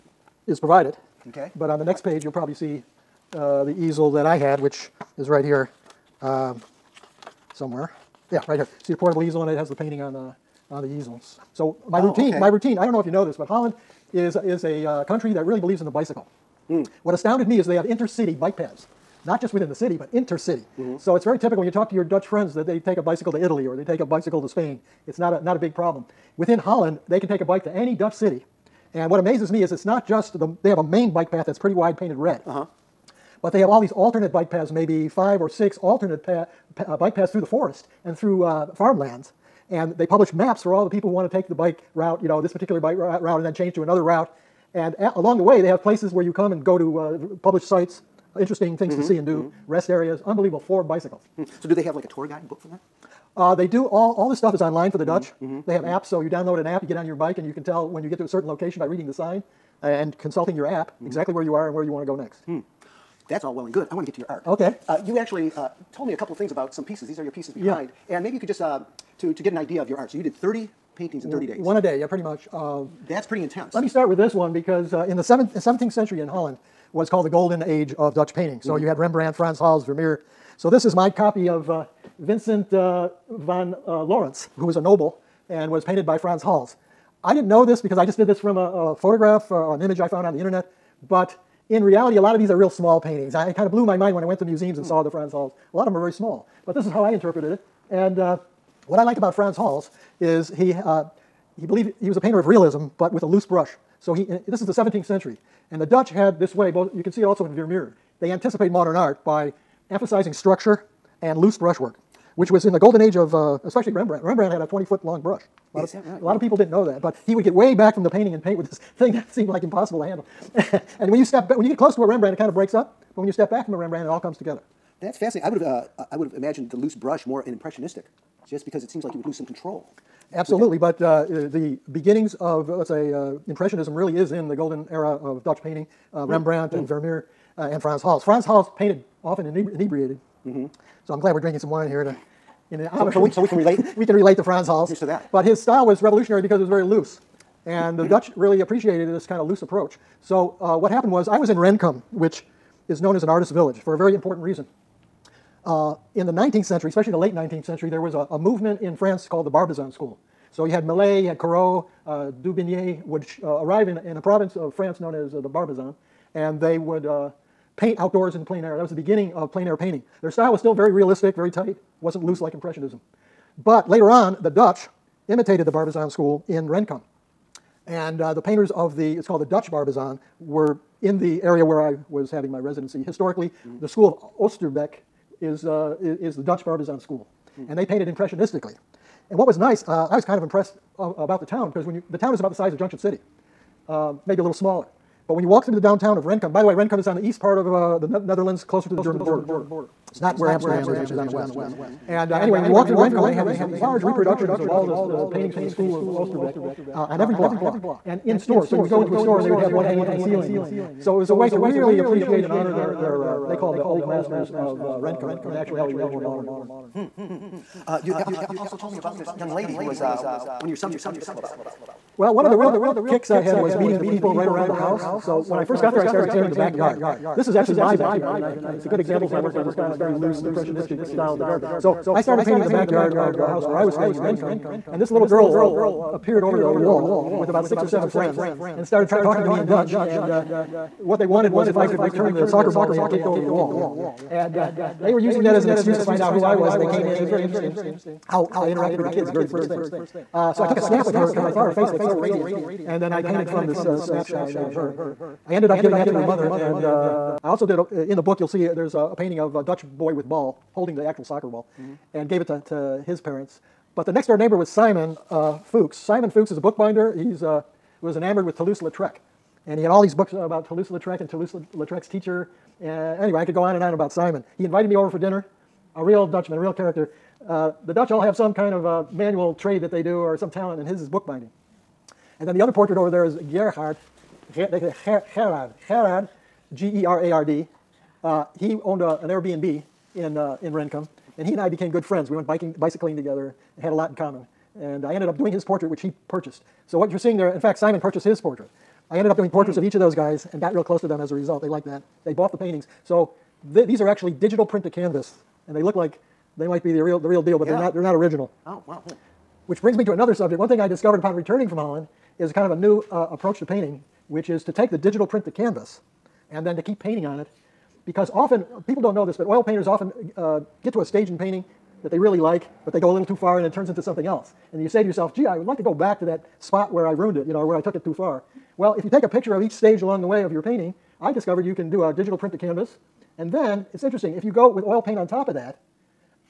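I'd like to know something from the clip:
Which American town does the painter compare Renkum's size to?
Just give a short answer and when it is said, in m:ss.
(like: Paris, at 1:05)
Junction City, at 3:12.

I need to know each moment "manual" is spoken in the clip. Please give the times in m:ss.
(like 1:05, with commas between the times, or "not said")
4:39.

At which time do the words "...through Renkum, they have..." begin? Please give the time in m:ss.
3:22.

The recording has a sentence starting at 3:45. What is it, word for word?
So when I first got there, I started painting the backyard.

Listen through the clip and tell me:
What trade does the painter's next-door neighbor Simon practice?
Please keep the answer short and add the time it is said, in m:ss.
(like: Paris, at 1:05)
Bookbinding, at 4:26.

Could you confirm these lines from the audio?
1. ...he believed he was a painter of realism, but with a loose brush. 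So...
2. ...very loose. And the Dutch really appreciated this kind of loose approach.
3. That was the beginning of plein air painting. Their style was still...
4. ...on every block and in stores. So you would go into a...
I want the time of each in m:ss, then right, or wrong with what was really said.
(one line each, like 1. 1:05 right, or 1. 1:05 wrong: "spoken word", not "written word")
1. 1:41 right
2. 2:26 right
3. 2:48 right
4. 3:27 right.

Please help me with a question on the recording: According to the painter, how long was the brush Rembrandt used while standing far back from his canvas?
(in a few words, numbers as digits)
20 feet.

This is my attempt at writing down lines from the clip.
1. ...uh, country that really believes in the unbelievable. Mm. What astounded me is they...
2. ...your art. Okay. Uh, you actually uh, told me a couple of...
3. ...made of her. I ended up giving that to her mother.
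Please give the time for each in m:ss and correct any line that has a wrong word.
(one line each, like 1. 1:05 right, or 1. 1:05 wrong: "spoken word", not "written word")
1. 0:14 wrong: "bicycle", not "unbelievable"
2. 1:04 right
3. 4:14 right.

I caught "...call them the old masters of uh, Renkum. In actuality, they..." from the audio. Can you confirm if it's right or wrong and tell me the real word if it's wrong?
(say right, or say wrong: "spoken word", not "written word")
right.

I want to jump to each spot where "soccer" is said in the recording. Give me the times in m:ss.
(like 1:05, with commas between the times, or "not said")
4:02, 4:21.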